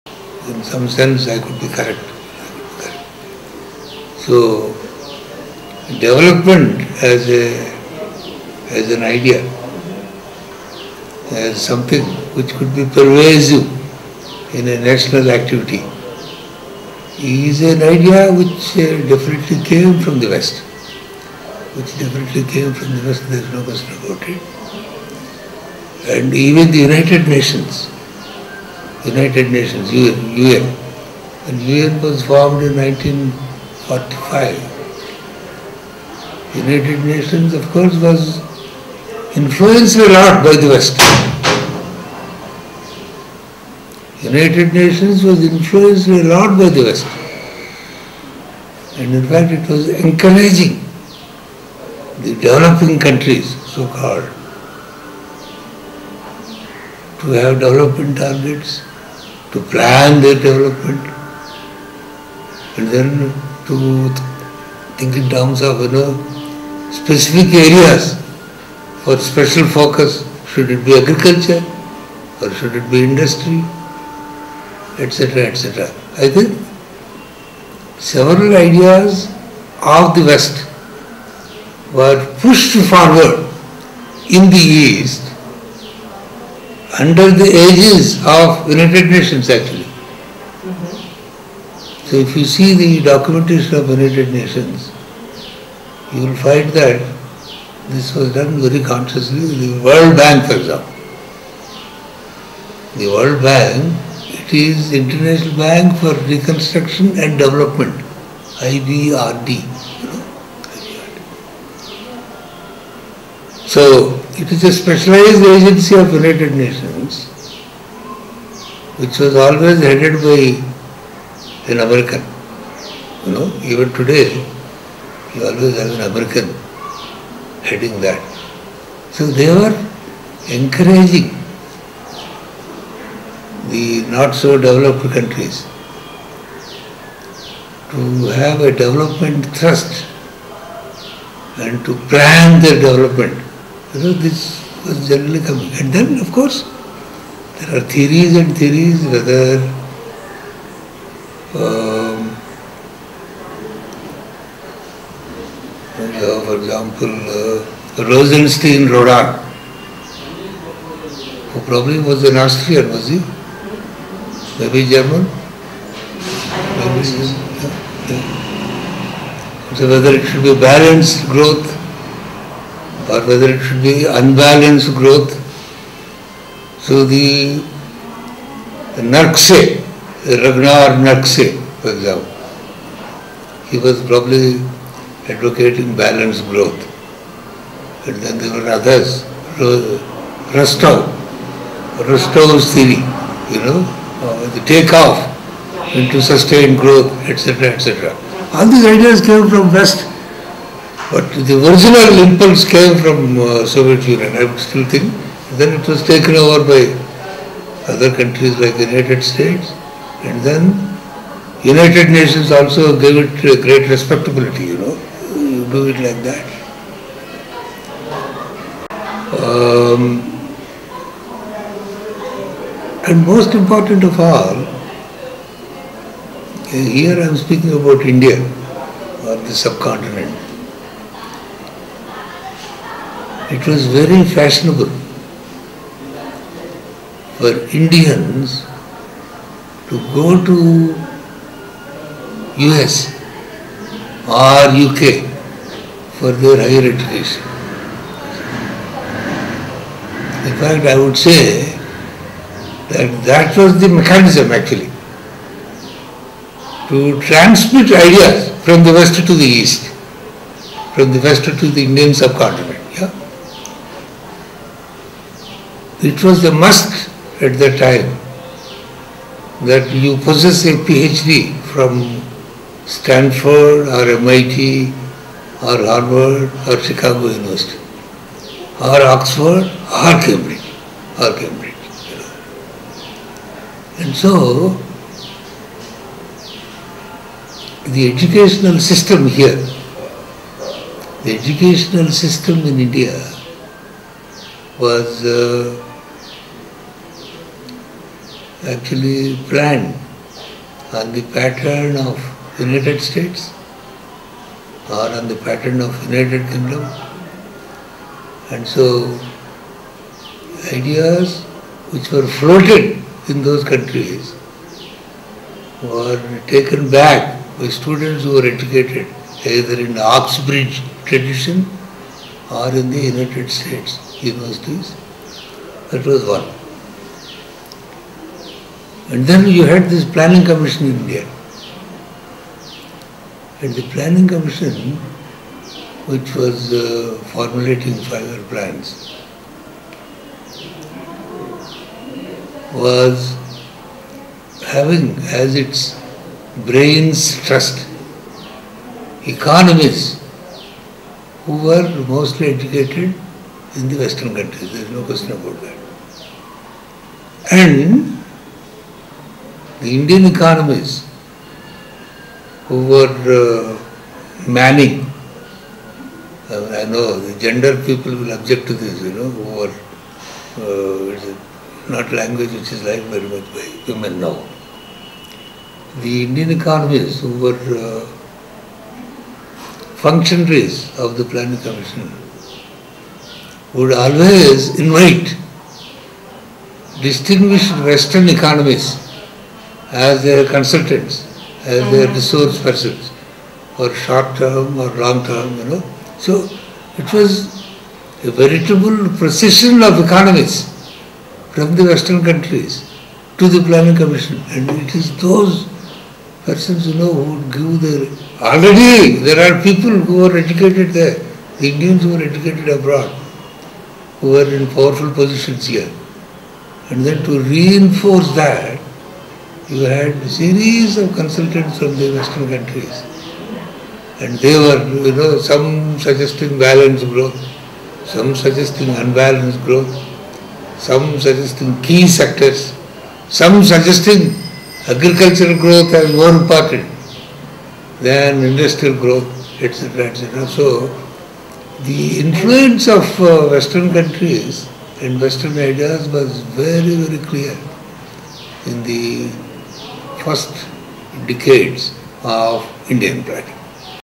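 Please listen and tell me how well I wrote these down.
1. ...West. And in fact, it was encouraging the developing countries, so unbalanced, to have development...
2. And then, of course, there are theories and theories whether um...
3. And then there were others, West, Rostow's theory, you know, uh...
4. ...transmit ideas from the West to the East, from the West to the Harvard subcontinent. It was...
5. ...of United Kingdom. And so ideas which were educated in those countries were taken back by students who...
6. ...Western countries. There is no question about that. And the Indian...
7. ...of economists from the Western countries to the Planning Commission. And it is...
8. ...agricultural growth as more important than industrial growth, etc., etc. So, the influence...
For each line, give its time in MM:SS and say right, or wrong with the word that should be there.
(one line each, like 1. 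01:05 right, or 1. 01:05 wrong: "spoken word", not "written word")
1. 00:46 wrong: "called", not "unbalanced"
2. 02:25 right
3. 03:08 wrong: "Rostow", not "West"
4. 04:17 wrong: "Indian", not "Harvard"
5. 05:05 wrong: "floated", not "educated"
6. 05:53 right
7. 06:39 right
8. 07:14 right.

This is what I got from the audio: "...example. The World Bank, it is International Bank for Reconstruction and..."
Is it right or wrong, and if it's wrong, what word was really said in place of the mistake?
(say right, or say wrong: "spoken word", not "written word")
right.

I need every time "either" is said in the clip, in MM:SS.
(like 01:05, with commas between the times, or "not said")
05:19.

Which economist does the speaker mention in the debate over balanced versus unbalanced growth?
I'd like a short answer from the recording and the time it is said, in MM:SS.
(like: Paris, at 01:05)
Rosenstein Rodan, at 02:38.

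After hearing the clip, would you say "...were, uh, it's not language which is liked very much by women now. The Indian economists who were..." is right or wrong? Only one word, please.
right.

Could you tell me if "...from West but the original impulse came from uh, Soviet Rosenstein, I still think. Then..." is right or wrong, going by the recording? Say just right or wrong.
wrong.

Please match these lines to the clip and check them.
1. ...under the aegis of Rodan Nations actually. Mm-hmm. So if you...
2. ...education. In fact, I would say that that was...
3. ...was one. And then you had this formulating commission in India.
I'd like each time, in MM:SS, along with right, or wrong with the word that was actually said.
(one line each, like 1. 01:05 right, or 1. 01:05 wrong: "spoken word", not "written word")
1. 01:26 wrong: "United", not "Rodan"
2. 04:06 right
3. 05:26 wrong: "planning", not "formulating".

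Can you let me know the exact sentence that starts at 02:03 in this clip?
You know, even today you always have an American heading that.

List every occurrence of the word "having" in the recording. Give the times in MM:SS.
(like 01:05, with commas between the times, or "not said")
05:44.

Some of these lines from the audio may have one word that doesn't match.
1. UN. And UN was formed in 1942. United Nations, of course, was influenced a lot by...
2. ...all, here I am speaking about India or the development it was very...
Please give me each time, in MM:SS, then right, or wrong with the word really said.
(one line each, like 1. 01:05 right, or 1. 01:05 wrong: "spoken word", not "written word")
1. 00:30 wrong: "1945", not "1942"
2. 03:44 wrong: "subcontinent", not "development".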